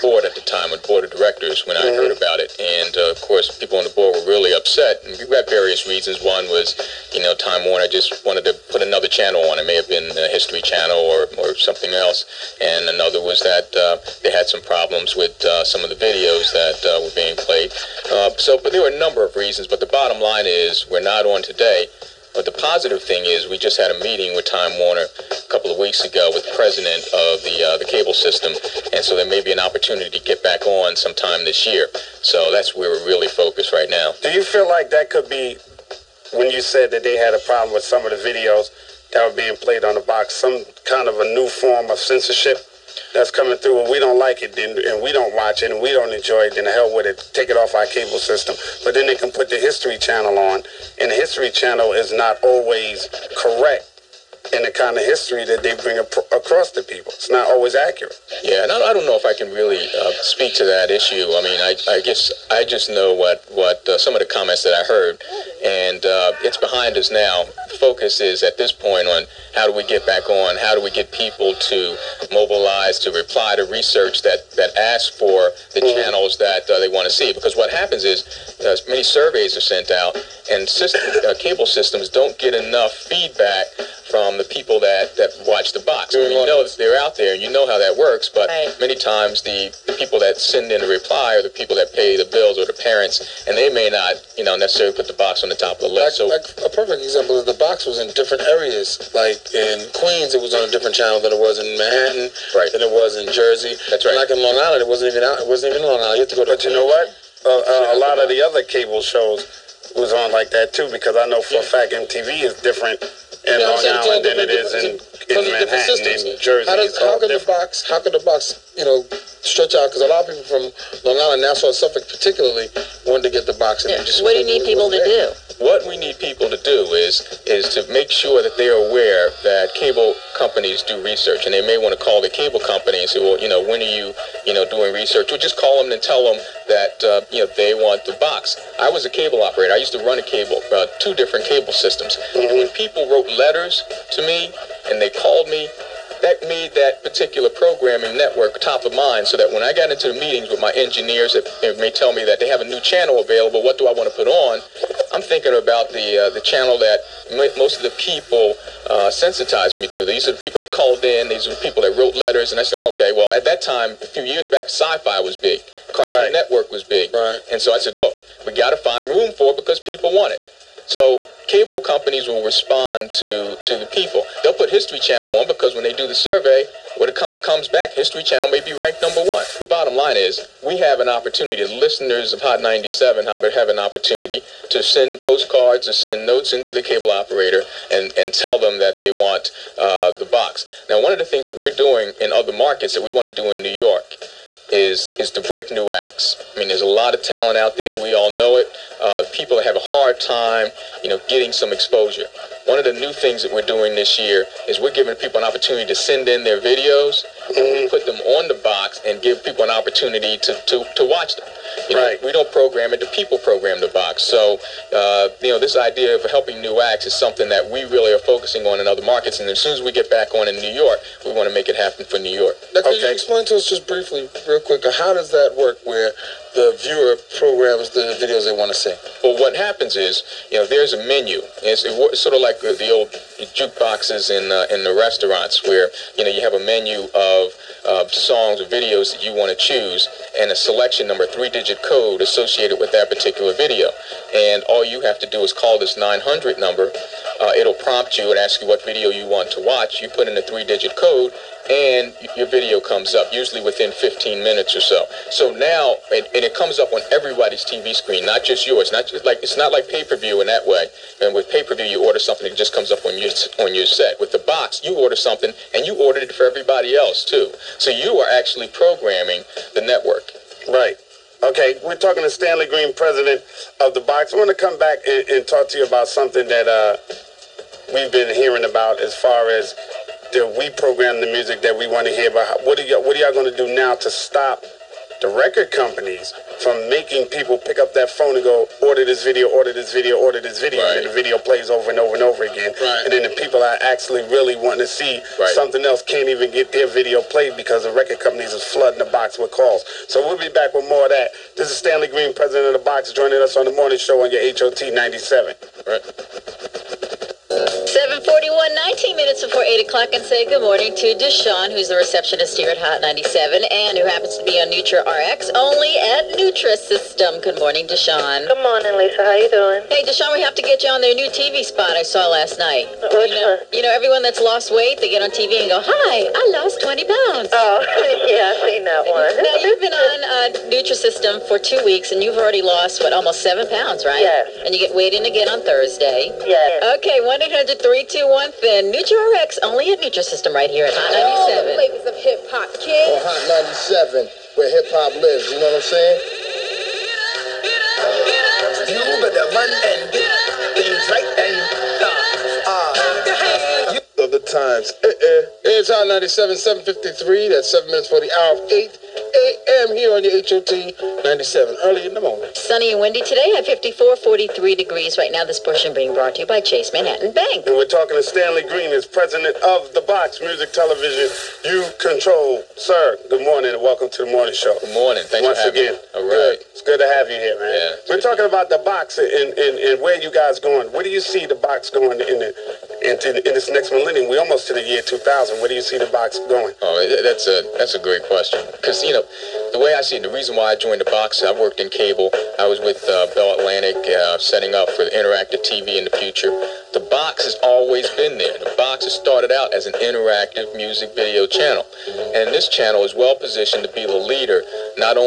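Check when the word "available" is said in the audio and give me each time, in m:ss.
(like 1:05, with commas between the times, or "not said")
2:33.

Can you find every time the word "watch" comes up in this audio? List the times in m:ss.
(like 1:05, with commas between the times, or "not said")
0:45, 1:25, 3:31, 4:09.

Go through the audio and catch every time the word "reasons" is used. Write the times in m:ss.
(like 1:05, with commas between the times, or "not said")
0:05, 0:19, 6:30.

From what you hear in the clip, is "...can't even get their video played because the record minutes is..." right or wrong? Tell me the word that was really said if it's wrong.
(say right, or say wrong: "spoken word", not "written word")
wrong: "companies", not "minutes".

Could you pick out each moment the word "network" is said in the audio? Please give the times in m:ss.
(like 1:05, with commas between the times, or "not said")
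2:28, 2:46, 4:29.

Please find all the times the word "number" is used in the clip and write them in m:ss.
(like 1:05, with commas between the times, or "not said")
0:19, 2:59, 4:01, 4:06.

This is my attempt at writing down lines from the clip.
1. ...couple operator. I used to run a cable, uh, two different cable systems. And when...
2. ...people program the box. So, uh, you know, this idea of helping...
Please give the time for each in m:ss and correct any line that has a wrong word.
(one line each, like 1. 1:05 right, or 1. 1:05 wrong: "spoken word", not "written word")
1. 2:19 wrong: "cable", not "couple"
2. 3:33 right.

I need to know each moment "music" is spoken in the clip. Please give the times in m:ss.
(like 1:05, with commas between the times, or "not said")
4:41, 6:10, 6:40.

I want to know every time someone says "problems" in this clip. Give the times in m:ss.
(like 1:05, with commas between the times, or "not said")
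0:14, 0:37.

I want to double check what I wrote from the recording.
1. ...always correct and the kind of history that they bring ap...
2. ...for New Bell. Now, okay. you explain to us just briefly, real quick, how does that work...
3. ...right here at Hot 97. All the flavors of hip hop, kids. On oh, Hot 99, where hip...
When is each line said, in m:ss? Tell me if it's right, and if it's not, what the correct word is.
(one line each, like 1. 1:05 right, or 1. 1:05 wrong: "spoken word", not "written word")
1. 0:52 right
2. 3:42 wrong: "York", not "Bell"
3. 5:40 wrong: "97", not "99".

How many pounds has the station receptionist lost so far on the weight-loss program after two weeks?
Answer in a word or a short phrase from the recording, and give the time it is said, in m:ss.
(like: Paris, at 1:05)
7, at 5:33.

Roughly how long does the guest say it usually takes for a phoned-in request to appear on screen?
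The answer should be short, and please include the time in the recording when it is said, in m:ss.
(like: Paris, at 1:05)
15 minutes, at 4:13.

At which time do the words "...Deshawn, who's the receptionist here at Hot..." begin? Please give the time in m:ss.
5:11.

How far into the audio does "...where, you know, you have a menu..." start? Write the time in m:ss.
3:55.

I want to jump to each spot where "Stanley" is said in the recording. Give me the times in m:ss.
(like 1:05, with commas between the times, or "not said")
4:32, 5:01, 6:08.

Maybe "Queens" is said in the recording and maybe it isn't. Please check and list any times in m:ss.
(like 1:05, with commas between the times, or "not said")
1:39, 1:46.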